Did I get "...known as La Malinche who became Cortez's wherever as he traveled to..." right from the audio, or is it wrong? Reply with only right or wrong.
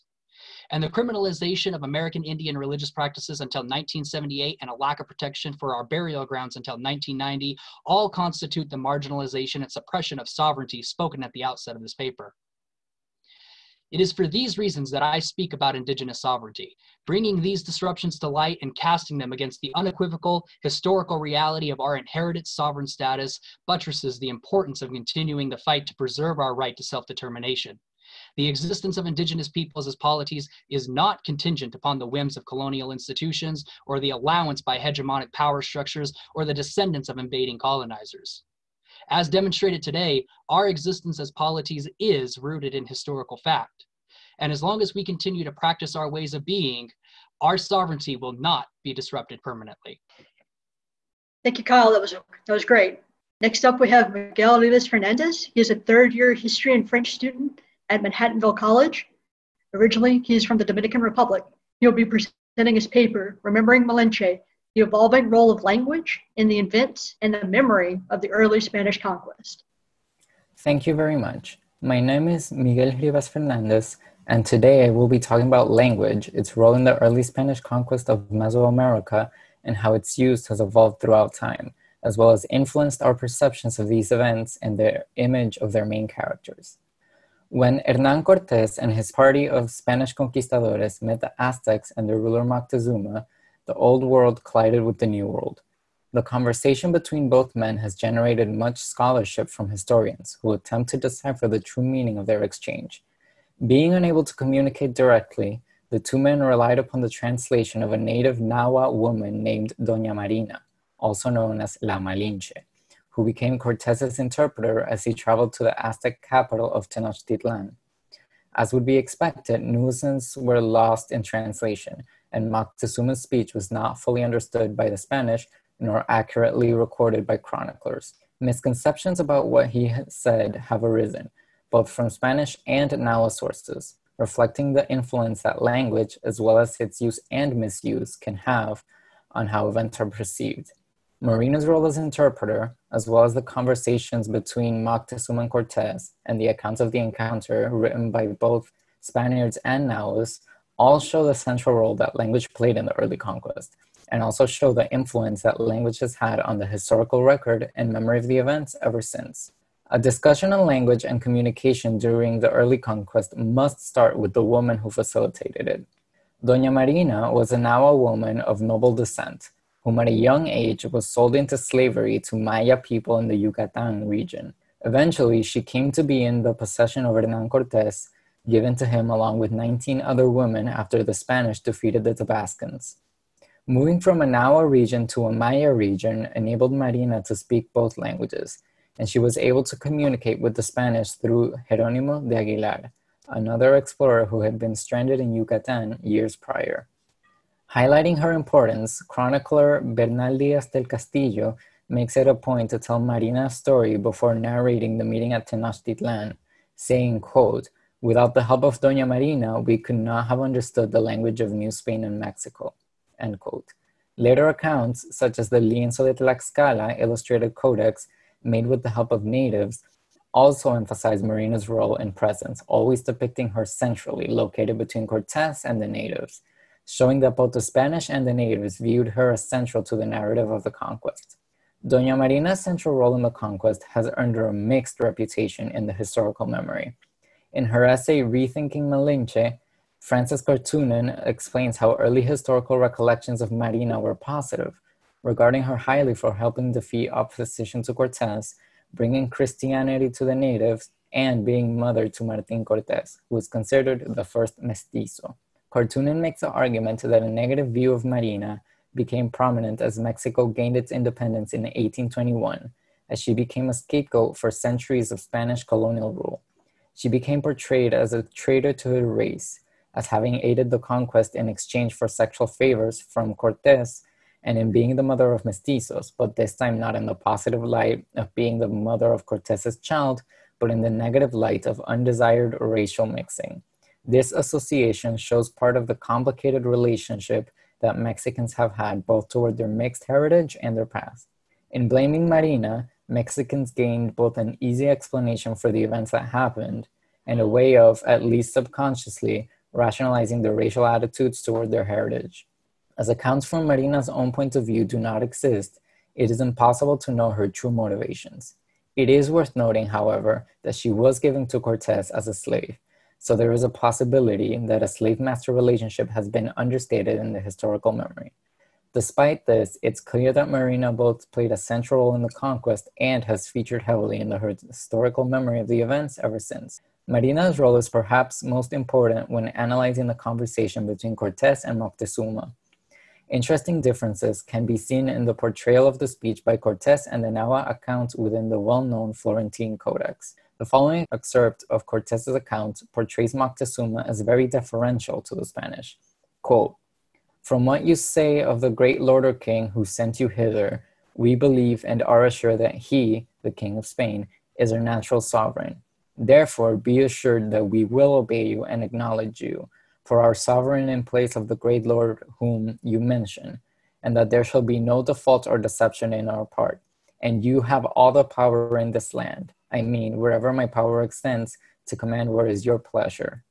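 wrong.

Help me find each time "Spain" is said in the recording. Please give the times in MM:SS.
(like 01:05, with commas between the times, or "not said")
03:31, 05:53.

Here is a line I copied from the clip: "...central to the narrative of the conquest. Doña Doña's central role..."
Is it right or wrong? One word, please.
wrong.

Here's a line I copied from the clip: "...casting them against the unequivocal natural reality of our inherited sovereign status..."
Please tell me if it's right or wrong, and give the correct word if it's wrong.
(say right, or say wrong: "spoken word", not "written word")
wrong: "historical", not "natural".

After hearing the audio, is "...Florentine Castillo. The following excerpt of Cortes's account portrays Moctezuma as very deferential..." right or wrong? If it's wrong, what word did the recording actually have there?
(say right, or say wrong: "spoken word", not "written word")
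wrong: "Codex", not "Castillo".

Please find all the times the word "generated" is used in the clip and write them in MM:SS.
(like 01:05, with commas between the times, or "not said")
01:37.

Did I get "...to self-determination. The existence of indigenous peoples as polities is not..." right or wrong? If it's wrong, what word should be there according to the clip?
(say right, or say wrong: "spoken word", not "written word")
right.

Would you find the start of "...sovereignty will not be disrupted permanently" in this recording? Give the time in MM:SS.
00:47.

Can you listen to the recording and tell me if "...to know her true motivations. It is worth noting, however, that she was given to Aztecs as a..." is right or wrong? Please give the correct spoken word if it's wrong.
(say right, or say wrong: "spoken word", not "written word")
wrong: "Cortes", not "Aztecs".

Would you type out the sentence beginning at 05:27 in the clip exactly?
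Marina's role is perhaps most important when analyzing the conversation between Cortes and Moctezuma.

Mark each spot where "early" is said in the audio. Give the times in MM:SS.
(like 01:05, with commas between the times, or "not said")
01:08, 01:17, 02:32, 02:42, 04:01.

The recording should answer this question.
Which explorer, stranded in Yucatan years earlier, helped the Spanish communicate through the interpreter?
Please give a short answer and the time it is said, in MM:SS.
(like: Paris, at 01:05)
Jeronimo de Aguilar, at 03:11.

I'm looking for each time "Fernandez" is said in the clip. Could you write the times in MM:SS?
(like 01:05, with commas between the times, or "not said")
00:54, 01:13.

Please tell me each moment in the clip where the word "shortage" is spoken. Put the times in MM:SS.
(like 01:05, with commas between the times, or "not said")
not said.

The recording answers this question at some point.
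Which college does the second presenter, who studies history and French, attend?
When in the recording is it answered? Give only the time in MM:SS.
00:58.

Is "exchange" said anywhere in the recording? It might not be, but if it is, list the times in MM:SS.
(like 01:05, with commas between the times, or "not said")
01:42, 04:31.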